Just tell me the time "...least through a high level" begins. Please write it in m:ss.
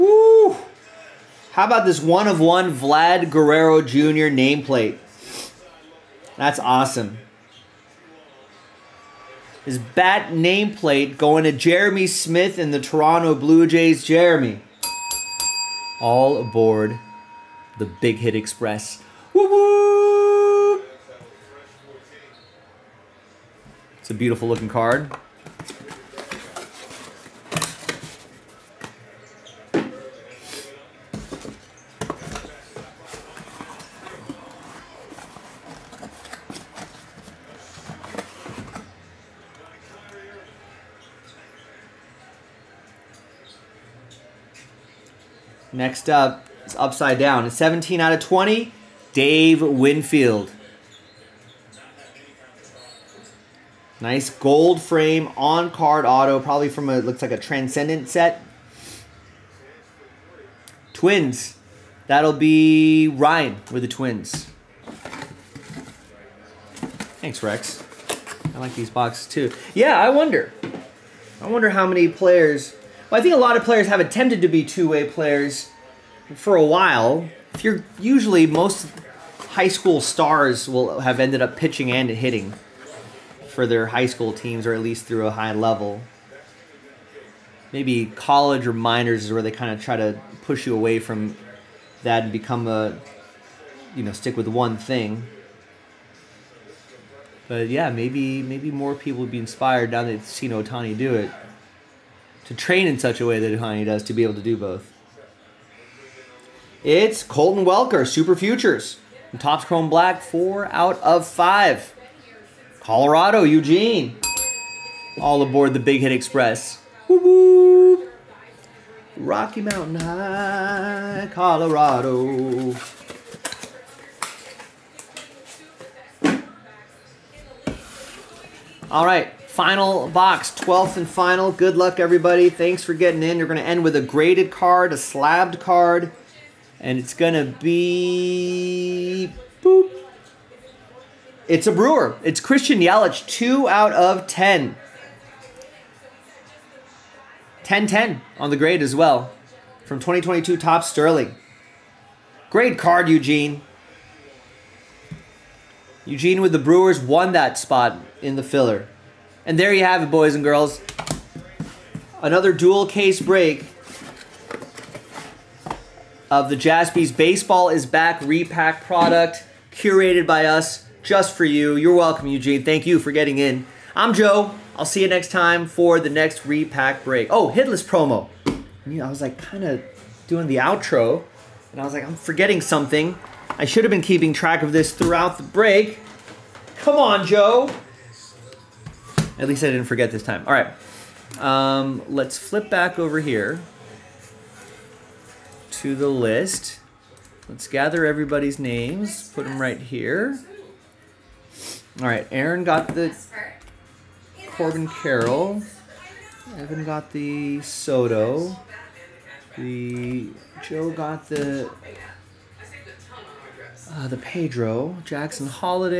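1:24.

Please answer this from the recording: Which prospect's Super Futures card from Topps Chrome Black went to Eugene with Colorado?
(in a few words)
Colton Welker.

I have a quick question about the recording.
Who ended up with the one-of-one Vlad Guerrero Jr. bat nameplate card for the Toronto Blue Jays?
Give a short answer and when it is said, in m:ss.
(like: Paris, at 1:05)
Jeremy Smith, at 0:11.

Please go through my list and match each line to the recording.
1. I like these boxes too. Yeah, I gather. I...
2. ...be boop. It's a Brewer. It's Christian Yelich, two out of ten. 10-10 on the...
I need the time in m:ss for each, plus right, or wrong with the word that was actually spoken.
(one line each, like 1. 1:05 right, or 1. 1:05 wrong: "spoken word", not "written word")
1. 1:08 wrong: "wonder", not "gather"
2. 2:17 right.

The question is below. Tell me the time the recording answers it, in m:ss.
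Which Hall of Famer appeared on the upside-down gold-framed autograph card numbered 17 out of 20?
0:49.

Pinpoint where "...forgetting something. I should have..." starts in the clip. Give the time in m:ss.
3:02.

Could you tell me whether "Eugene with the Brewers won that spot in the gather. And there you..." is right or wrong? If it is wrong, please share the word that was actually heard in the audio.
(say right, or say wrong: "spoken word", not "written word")
wrong: "filler", not "gather".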